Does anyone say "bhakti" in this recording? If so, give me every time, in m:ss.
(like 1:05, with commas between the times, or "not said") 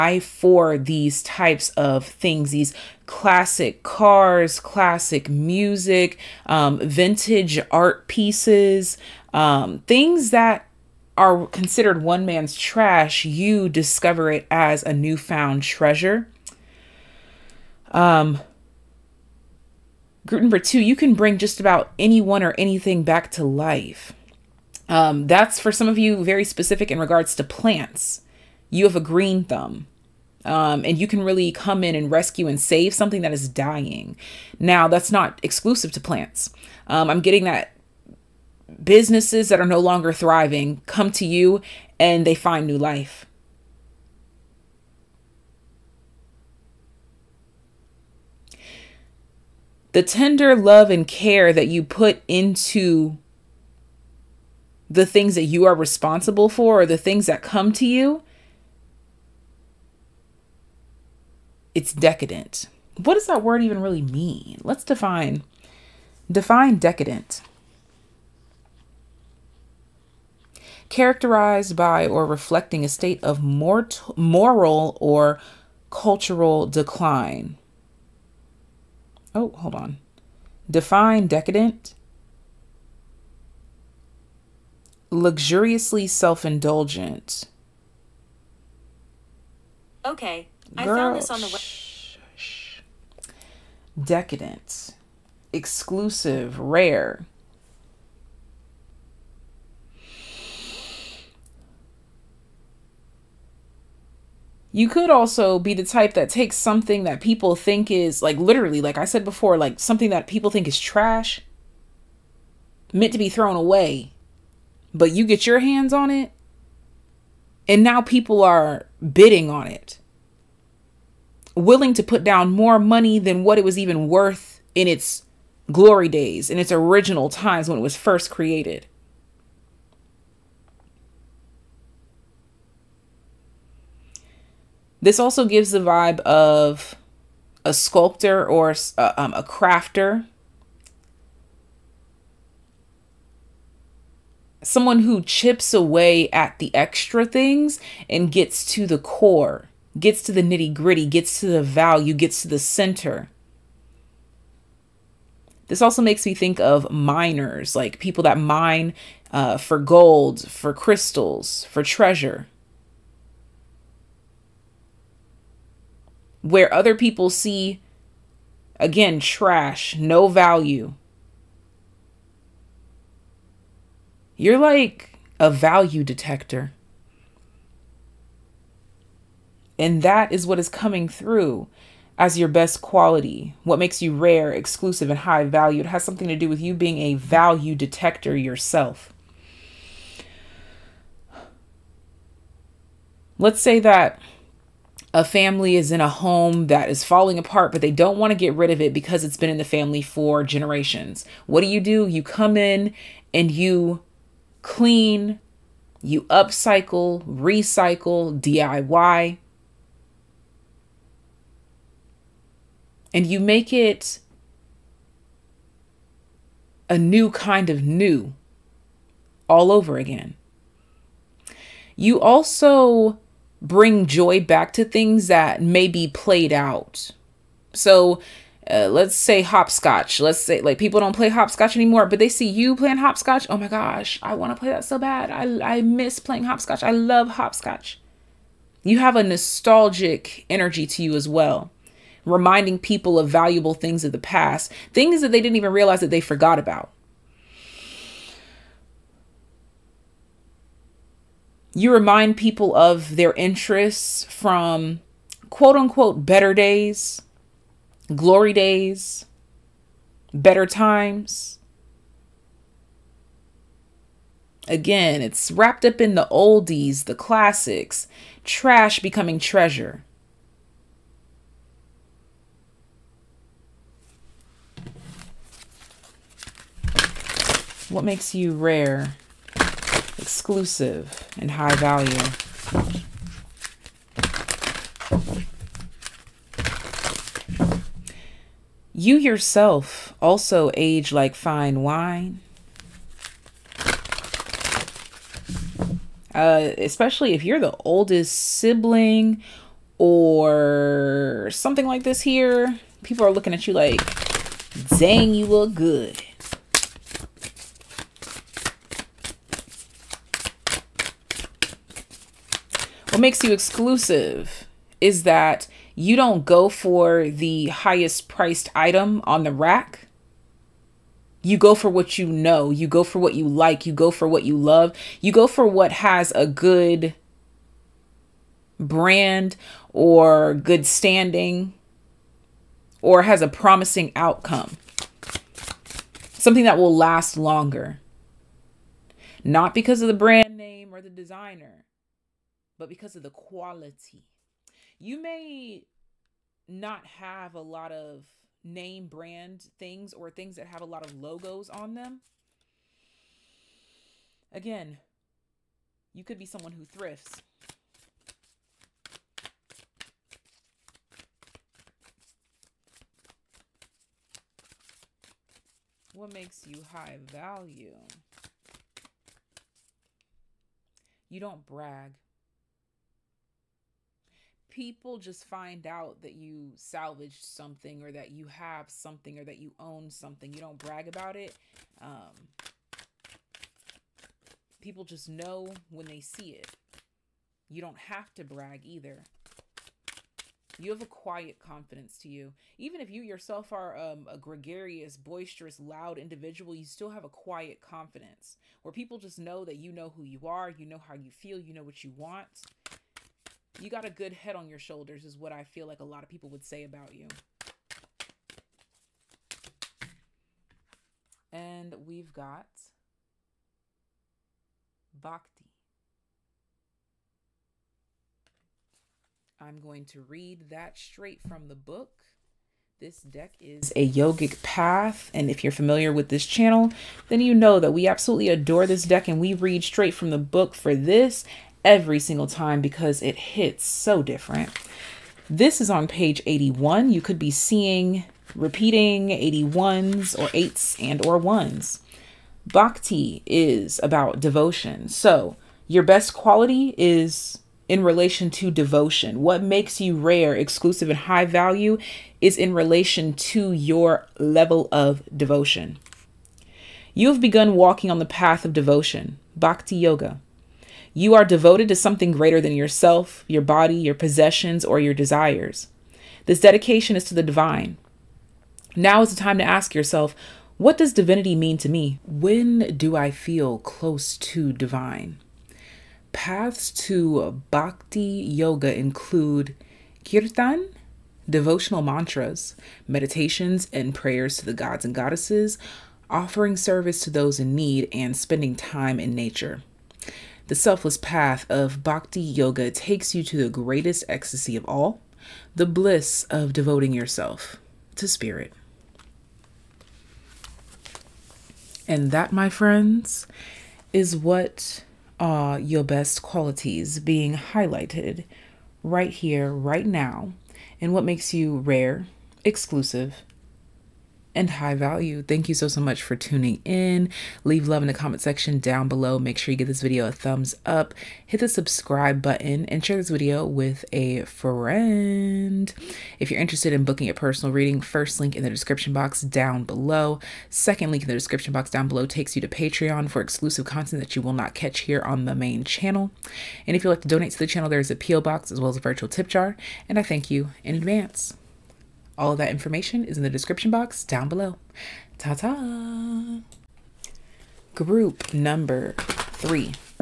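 6:55, 7:22, 7:39, 7:57, 8:12.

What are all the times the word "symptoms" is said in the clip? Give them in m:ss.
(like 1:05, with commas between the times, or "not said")
not said.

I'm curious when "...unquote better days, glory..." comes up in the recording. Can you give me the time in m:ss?
4:15.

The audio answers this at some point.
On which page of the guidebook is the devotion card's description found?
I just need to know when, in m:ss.
7:16.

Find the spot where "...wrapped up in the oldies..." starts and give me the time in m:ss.
4:25.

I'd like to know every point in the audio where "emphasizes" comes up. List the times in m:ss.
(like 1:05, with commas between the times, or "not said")
not said.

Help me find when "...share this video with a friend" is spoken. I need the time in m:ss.
8:43.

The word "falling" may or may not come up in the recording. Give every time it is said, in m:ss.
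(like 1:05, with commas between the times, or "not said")
3:17.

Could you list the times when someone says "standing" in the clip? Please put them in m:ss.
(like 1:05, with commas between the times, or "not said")
5:30.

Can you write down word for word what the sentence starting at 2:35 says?
This also makes me think of miners, like people that mine uh, for gold, for crystals, for treasure.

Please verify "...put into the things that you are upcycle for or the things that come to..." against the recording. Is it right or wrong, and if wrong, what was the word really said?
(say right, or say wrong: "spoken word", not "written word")
wrong: "responsible", not "upcycle".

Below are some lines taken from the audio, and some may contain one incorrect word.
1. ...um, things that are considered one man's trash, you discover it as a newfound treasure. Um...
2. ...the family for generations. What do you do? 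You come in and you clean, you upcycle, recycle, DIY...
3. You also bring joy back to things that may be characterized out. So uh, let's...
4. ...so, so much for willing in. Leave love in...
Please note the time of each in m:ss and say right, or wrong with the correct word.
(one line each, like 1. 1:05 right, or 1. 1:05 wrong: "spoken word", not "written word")
1. 0:09 right
2. 3:19 right
3. 3:41 wrong: "played", not "characterized"
4. 8:35 wrong: "tuning", not "willing".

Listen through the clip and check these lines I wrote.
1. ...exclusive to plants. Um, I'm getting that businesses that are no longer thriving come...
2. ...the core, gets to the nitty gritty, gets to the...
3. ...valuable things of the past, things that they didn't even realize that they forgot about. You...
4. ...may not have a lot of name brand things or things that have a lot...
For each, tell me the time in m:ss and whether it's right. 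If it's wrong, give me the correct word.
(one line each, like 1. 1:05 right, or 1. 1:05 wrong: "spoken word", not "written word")
1. 0:35 right
2. 2:28 right
3. 4:03 right
4. 5:45 right.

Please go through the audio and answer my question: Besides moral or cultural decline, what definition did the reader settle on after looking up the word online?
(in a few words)
Luxuriously self indulgent.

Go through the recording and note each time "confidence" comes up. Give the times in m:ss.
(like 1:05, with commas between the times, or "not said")
6:31, 6:37.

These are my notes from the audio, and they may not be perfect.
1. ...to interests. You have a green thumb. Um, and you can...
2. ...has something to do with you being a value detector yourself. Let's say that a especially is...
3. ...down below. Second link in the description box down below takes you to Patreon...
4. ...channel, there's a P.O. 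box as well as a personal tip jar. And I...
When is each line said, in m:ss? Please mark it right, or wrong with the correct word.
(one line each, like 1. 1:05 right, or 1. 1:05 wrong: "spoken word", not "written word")
1. 0:27 wrong: "plants", not "interests"
2. 3:05 wrong: "family", not "especially"
3. 8:49 right
4. 8:57 wrong: "virtual", not "personal".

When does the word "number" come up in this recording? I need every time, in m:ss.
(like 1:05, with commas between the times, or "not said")
0:20, 9:08.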